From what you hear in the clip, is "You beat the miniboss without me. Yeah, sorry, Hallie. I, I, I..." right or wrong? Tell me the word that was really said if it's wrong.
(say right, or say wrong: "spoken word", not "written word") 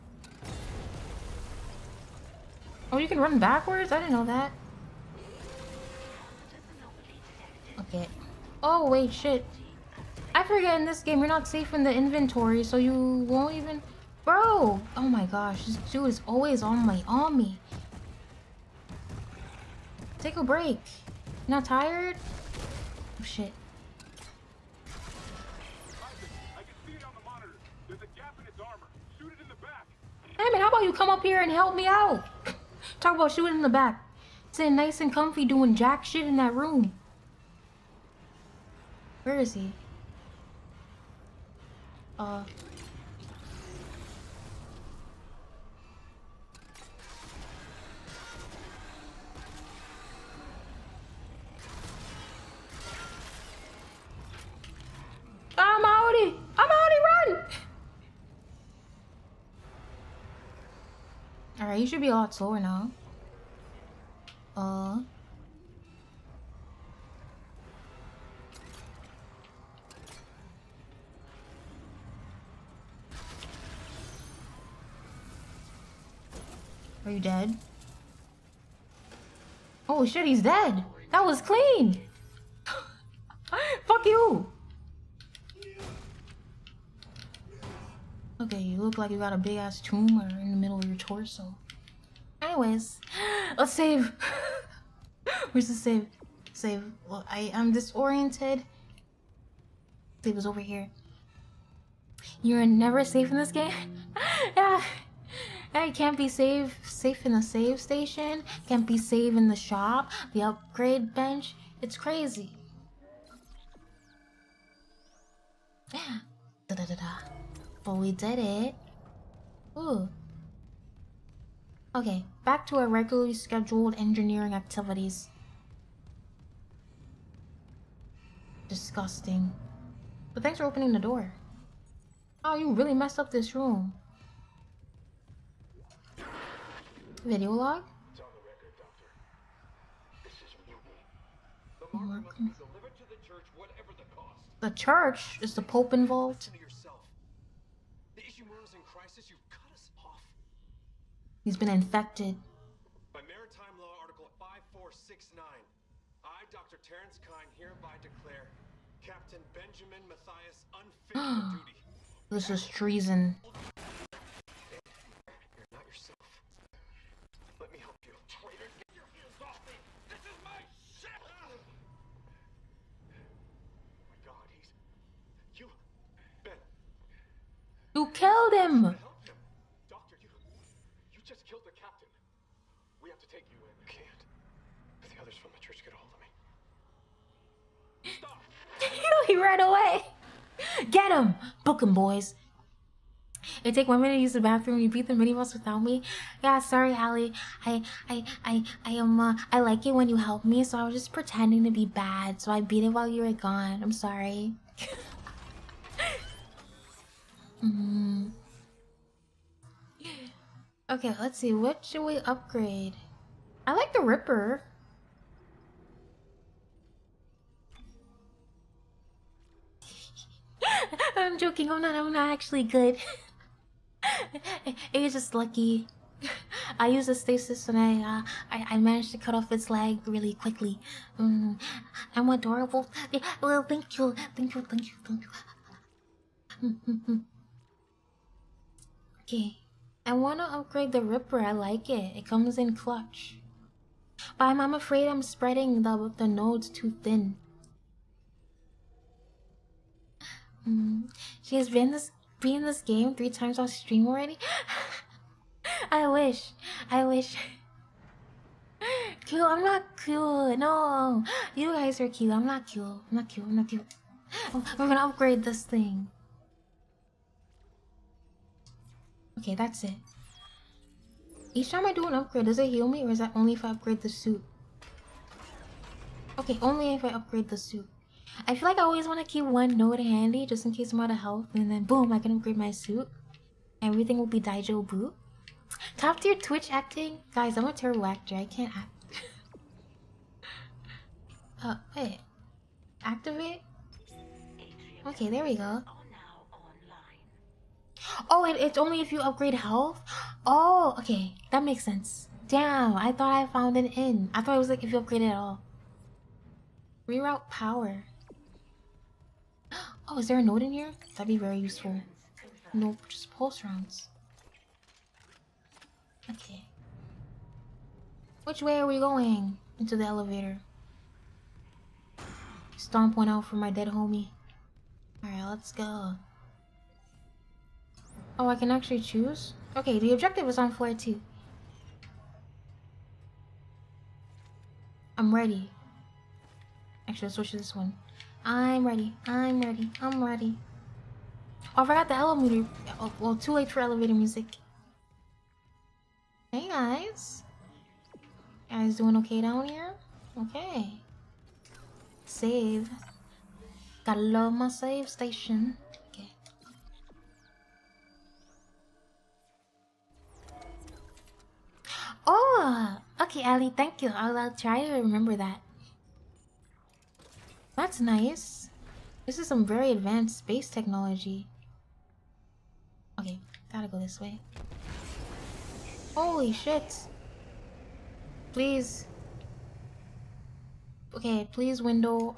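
right.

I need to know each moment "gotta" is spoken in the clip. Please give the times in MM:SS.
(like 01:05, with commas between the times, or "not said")
05:54, 06:13.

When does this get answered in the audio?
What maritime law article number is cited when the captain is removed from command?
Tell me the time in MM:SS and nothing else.
02:34.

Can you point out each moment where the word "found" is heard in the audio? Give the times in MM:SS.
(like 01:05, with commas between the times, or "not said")
05:03.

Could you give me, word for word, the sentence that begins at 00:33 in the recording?
Talk about shooting in the back.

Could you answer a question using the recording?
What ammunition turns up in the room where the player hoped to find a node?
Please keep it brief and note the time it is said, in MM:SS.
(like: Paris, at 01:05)
Pulse rounds, at 05:13.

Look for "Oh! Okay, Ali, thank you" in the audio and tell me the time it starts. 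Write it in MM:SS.
06:02.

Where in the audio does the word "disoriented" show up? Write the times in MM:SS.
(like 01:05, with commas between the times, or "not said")
01:37.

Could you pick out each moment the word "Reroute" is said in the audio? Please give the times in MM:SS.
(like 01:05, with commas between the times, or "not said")
05:07.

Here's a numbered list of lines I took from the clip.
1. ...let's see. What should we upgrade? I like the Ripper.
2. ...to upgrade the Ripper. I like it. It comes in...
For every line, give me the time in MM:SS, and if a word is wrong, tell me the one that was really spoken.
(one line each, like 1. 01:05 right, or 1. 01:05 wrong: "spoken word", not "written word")
1. 03:31 right
2. 04:00 right.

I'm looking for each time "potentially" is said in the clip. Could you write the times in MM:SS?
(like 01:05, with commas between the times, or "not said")
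not said.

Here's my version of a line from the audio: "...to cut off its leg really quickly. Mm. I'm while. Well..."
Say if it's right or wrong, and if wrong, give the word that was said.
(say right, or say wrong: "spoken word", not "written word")
wrong: "adorable", not "while".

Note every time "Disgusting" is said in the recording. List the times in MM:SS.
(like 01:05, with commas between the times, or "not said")
02:08.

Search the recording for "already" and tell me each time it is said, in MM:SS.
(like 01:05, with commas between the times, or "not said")
04:14.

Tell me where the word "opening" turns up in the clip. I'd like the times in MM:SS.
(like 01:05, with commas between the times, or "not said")
02:10.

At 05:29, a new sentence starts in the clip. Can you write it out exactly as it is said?
Okay, the objective is on floor two.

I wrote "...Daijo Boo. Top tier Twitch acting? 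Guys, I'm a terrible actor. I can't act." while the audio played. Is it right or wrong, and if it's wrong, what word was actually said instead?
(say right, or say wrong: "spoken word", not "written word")
right.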